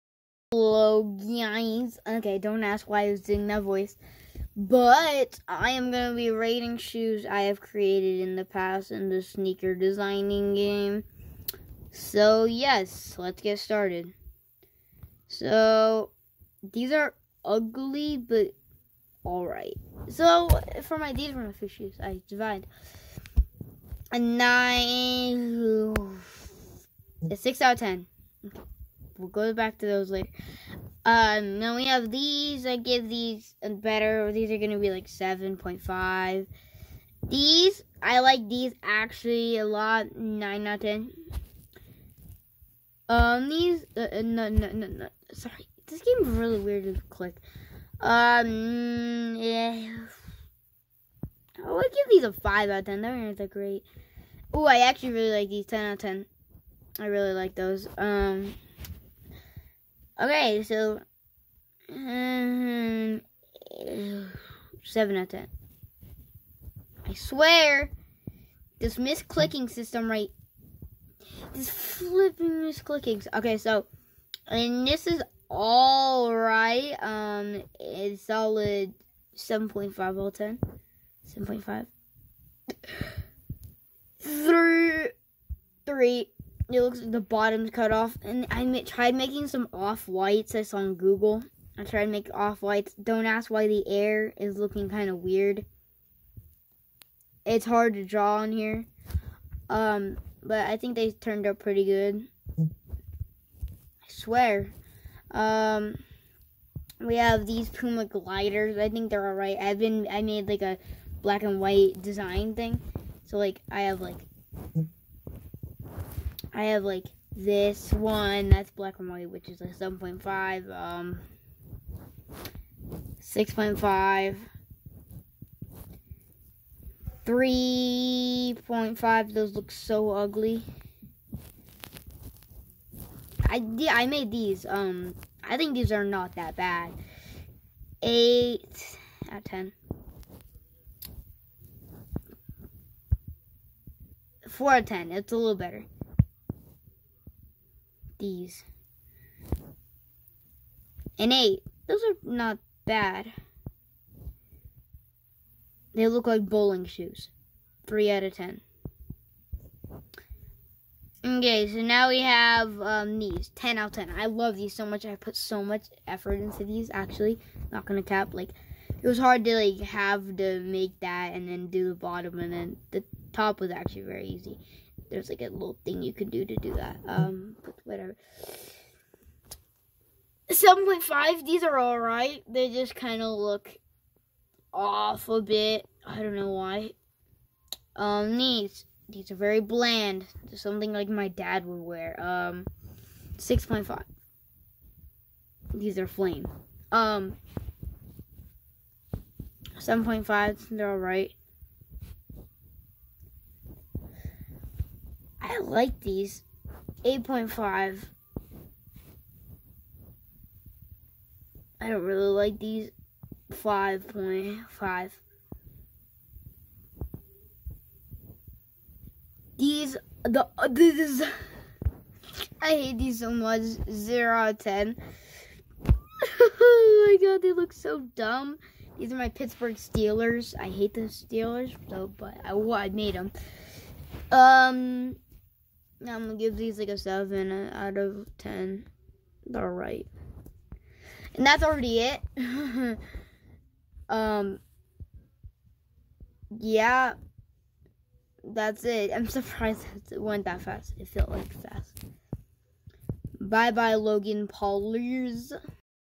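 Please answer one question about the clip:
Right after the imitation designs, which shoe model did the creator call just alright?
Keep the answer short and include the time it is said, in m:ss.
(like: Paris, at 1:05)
Puma gliders, at 1:47.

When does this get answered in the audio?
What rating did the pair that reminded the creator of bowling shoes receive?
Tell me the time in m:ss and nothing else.
2:37.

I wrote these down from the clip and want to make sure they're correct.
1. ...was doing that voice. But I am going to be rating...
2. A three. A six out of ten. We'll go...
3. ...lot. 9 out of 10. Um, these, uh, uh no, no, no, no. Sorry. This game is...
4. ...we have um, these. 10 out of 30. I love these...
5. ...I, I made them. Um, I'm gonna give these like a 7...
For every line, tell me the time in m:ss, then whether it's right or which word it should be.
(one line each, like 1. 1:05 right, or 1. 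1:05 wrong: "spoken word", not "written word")
1. 0:03 right
2. 0:24 wrong: "nine", not "three"
3. 0:39 right
4. 2:42 wrong: "10", not "30"
5. 3:52 right.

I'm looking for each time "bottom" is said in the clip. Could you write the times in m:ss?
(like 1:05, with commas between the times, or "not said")
1:27, 2:51.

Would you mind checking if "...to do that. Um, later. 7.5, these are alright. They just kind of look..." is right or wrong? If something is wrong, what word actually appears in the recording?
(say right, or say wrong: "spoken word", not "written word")
wrong: "whatever", not "later".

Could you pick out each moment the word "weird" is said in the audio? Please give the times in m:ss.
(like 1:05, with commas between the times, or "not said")
0:46, 1:35.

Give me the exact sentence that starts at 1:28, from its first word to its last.
And I tried making some off whites.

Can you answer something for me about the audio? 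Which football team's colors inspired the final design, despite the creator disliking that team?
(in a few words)
Pittsburgh Steelers.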